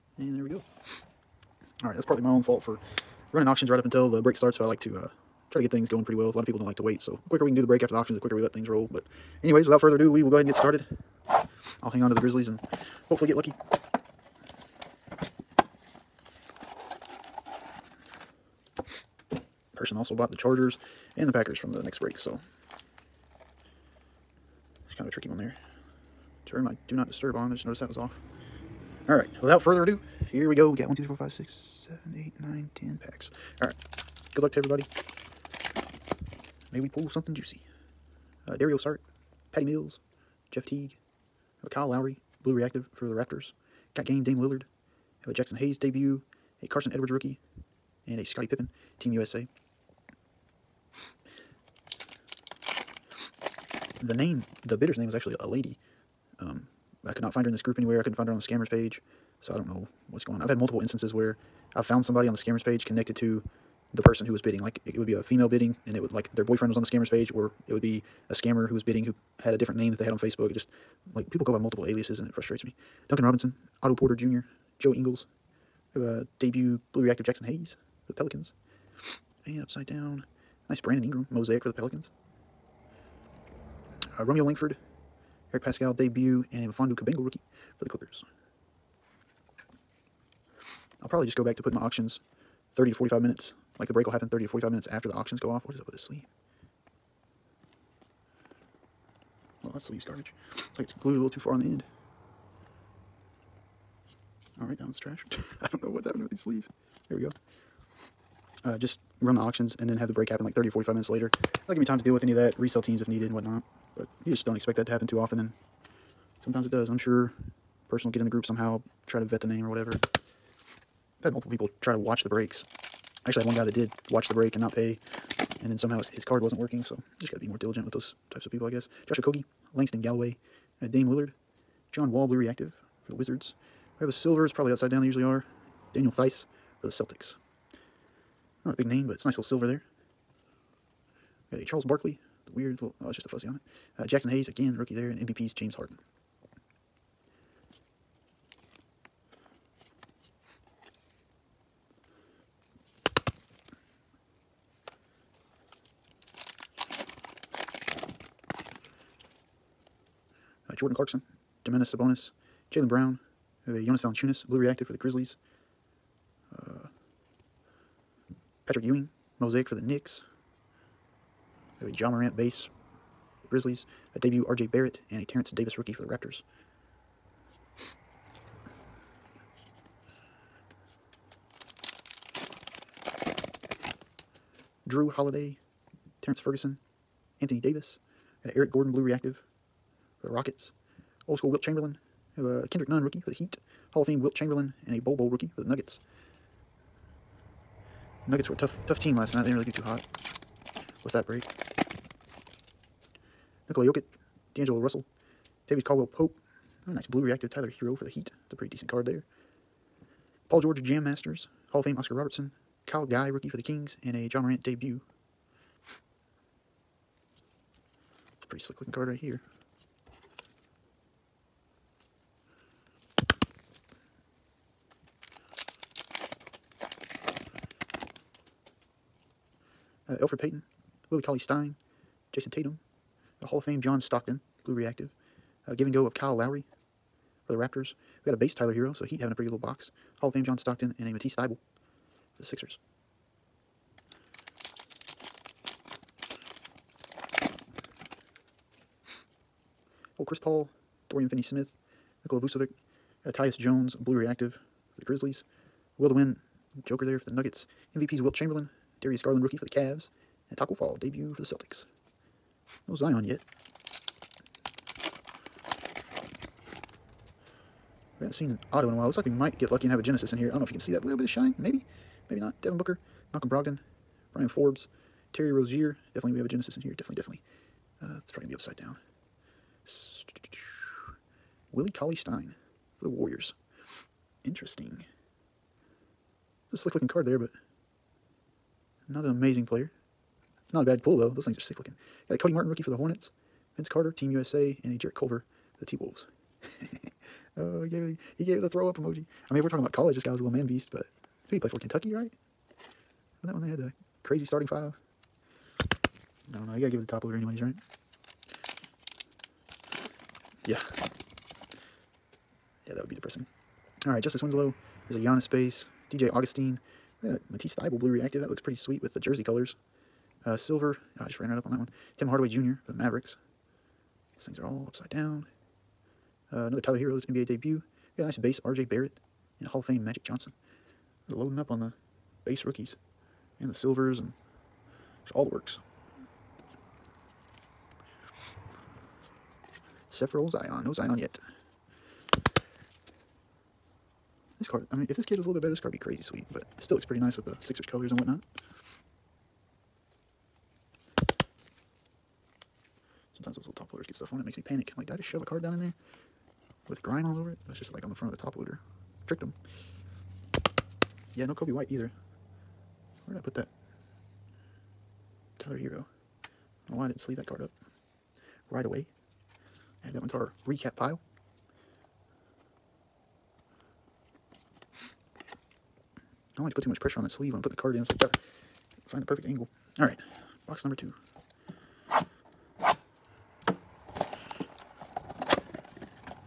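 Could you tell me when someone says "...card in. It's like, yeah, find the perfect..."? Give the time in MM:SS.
06:17.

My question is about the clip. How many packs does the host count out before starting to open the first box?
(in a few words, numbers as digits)
10.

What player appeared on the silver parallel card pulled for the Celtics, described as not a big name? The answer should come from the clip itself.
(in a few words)
Daniel Theis.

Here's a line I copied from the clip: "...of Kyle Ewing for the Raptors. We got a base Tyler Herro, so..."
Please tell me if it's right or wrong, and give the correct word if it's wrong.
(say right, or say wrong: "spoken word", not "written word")
wrong: "Lowry", not "Ewing".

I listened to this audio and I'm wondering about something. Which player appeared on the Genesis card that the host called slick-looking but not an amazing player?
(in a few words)
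Willie Cauley-Stein.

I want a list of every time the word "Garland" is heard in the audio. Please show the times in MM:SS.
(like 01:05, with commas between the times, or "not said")
04:19.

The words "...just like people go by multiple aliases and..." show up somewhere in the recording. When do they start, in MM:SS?
01:10.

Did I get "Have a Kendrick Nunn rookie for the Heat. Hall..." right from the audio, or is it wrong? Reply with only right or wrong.
right.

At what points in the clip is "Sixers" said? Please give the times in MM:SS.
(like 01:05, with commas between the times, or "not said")
04:02, 05:47.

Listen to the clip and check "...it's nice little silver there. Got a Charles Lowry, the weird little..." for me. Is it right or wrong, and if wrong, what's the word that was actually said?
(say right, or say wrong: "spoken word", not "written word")
wrong: "Barkley", not "Lowry".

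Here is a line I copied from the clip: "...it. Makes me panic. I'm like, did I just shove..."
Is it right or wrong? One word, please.
right.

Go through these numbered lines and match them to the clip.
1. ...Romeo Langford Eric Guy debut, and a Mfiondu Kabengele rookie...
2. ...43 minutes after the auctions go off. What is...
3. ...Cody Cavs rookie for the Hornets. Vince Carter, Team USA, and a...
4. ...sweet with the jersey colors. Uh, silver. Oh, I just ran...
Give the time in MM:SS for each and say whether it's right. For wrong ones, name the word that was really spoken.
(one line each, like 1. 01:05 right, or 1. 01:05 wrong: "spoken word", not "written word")
1. 01:24 wrong: "Paschall", not "Guy"
2. 01:34 wrong: "45", not "43"
3. 04:52 wrong: "Martin", not "Cavs"
4. 05:18 right.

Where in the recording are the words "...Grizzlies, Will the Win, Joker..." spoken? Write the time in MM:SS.
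04:15.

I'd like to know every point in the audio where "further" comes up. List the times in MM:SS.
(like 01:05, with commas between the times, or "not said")
00:09, 00:29.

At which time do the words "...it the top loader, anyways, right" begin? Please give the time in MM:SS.
05:06.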